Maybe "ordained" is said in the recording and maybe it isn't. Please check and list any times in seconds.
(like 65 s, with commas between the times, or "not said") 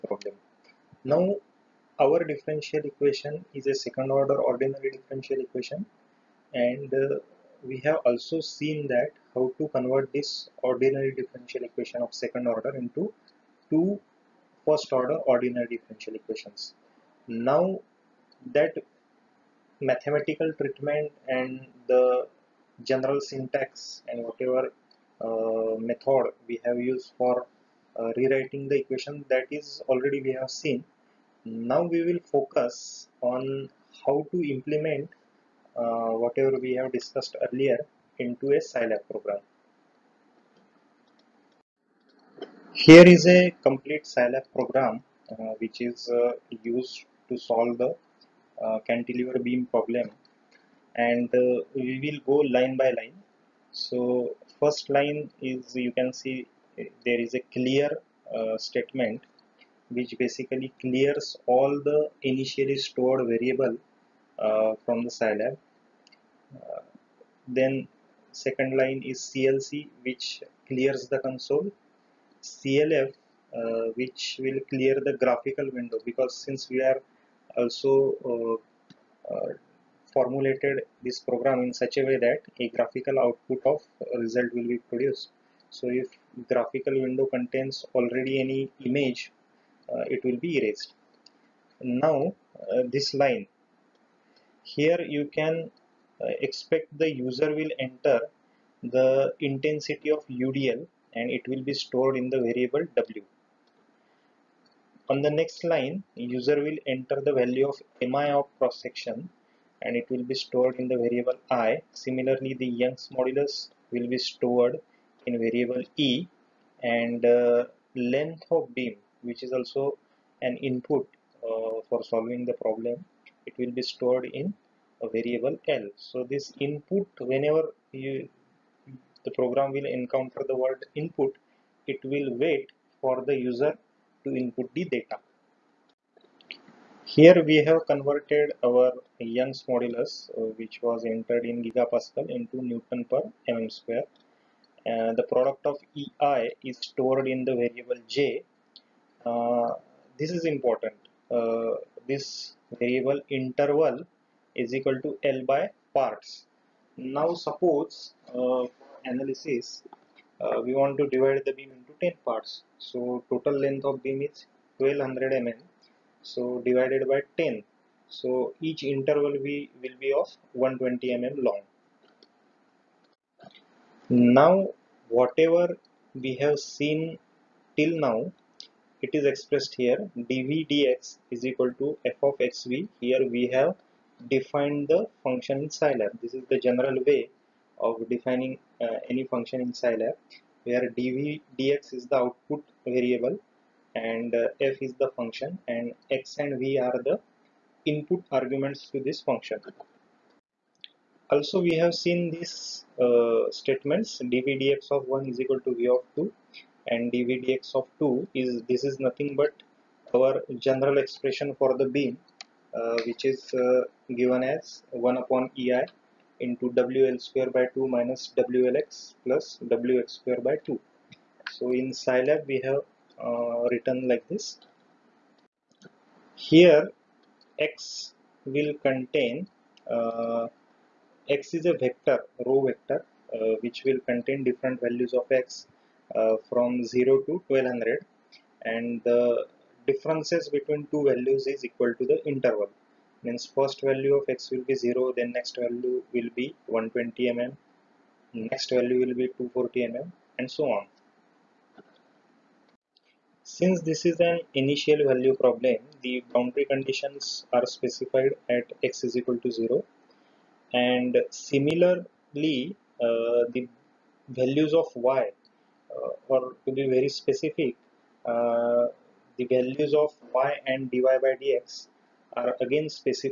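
not said.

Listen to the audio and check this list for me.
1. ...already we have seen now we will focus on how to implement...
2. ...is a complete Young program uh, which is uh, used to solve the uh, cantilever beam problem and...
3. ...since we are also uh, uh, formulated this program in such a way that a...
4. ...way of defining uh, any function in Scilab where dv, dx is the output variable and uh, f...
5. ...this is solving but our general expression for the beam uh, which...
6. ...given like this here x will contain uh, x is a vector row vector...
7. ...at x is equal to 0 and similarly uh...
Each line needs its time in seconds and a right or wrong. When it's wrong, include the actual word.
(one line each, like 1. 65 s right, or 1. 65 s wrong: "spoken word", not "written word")
1. 29 s right
2. 43 s wrong: "Scilab", not "Young"
3. 76 s right
4. 187 s right
5. 208 s wrong: "nothing", not "solving"
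6. 223 s wrong: "written", not "given"
7. 258 s right.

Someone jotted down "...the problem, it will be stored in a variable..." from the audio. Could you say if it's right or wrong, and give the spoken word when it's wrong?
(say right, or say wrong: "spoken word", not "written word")
right.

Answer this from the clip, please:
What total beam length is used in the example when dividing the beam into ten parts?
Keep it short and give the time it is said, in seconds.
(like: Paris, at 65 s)
1200 mm, at 164 s.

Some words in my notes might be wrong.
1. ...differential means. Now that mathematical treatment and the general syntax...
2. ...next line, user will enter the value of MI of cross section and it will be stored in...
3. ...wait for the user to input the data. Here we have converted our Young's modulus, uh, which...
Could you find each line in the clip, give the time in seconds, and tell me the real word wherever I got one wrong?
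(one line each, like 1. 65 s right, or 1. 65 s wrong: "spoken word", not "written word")
1. 15 s wrong: "equations", not "means"
2. 105 s right
3. 132 s right.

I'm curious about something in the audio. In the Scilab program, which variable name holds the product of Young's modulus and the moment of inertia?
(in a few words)
J.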